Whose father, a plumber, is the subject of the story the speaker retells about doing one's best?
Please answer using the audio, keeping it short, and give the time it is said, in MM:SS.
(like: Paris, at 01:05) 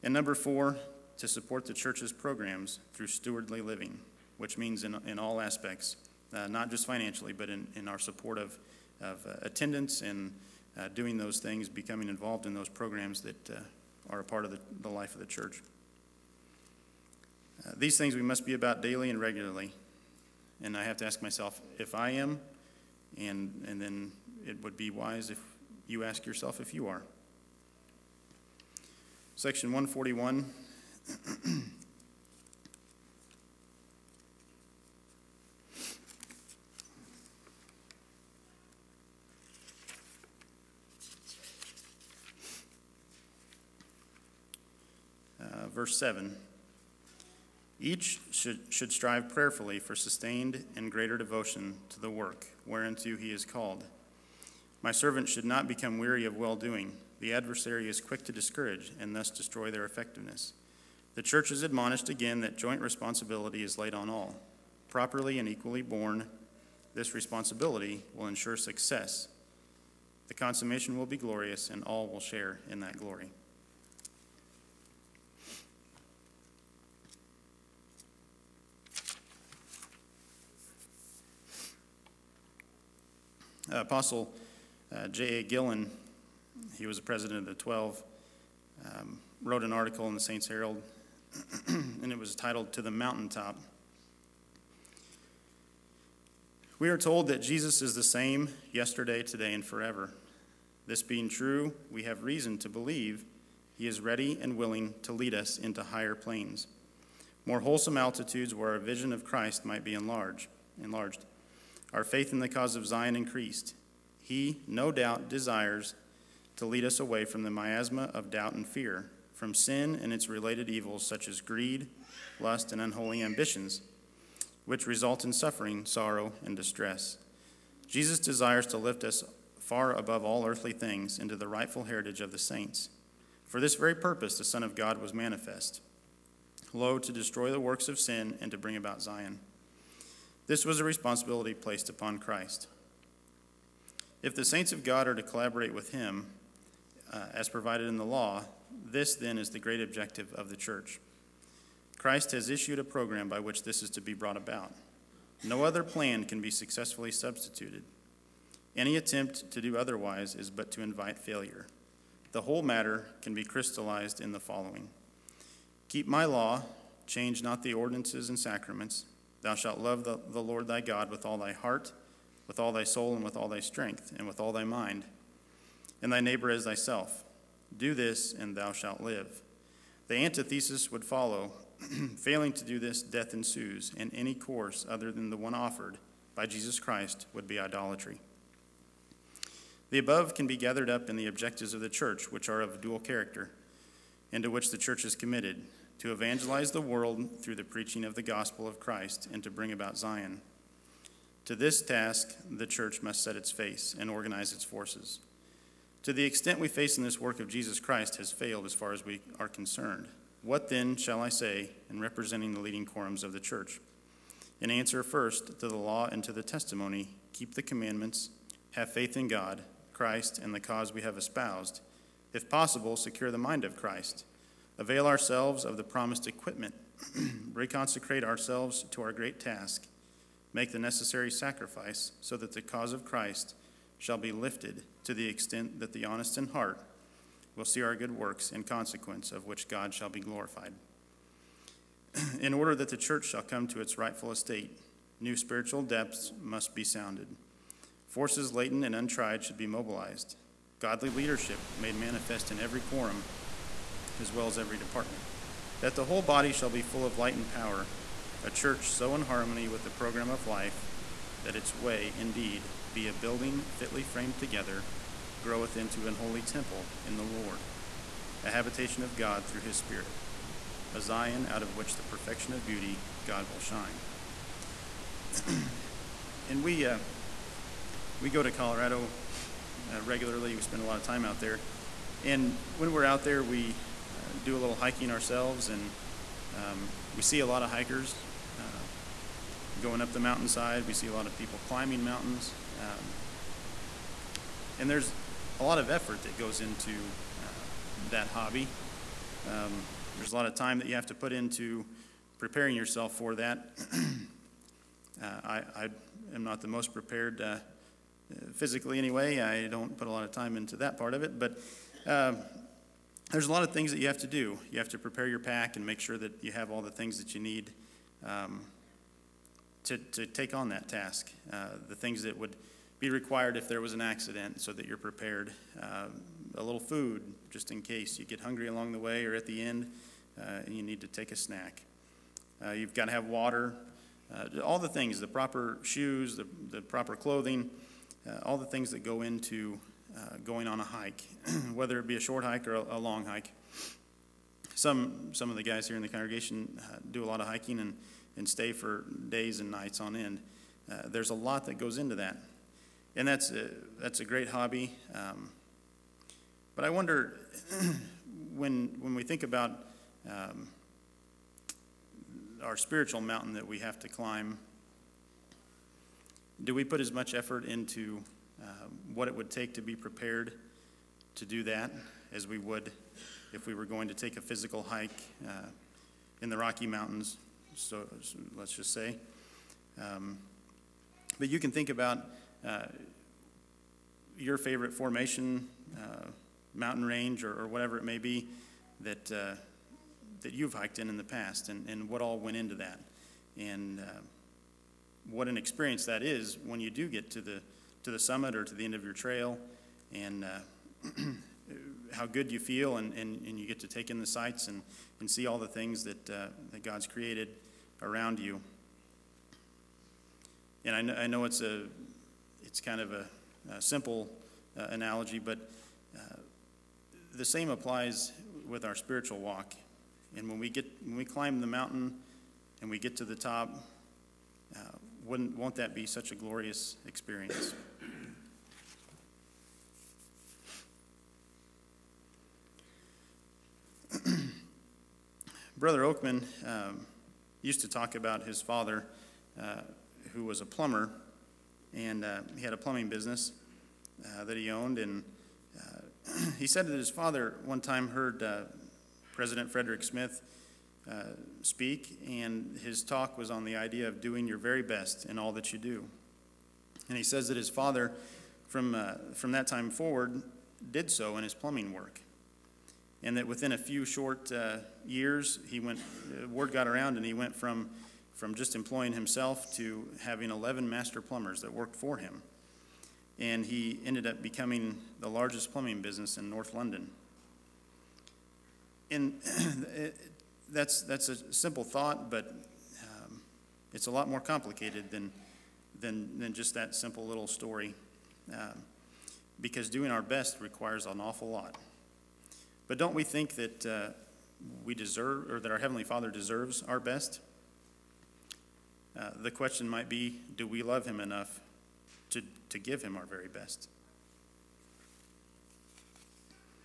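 Brother Oakman, at 07:15.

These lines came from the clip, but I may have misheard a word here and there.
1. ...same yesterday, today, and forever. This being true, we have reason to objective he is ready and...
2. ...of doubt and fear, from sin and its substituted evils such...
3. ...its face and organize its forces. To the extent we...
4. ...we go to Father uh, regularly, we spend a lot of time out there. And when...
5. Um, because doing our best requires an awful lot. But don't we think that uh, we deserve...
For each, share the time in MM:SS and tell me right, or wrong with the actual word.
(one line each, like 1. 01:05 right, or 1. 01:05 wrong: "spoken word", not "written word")
1. 01:38 wrong: "believe", not "objective"
2. 01:58 wrong: "related", not "substituted"
3. 03:23 right
4. 04:38 wrong: "Colorado", not "Father"
5. 08:08 right.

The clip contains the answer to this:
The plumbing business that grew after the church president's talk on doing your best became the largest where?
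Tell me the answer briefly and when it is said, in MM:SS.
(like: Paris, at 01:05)
North London, at 07:56.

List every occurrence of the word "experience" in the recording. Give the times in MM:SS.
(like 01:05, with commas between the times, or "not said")
06:35, 07:07.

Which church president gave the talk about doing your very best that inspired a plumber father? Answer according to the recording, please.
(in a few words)
Frederick Smith.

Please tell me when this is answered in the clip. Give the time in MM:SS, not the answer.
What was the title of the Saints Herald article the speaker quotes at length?
01:32.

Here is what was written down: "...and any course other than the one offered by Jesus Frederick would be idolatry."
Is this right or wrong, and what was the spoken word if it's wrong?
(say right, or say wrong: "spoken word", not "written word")
wrong: "Christ", not "Frederick".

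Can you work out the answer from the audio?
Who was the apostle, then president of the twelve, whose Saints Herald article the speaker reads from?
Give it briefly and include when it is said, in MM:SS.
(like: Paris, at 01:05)
J.A. Gillen, at 01:25.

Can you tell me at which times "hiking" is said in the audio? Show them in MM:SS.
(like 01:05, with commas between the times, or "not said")
04:44, 05:47.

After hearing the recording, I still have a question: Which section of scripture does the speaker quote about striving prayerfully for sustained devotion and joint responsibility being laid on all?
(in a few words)
Section 141.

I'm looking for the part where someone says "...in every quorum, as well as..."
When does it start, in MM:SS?
04:12.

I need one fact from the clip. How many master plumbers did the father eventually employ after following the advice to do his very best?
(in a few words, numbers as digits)
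11.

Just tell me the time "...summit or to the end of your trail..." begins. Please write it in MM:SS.
06:38.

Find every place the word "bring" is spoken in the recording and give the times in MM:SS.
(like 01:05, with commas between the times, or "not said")
02:18, 03:19.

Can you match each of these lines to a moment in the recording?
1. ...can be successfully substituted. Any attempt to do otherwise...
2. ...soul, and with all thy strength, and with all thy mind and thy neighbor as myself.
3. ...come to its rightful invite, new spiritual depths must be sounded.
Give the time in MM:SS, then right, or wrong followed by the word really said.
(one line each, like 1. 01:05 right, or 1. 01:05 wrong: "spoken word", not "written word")
1. 02:36 right
2. 02:52 wrong: "thyself", not "myself"
3. 04:03 wrong: "estate", not "invite".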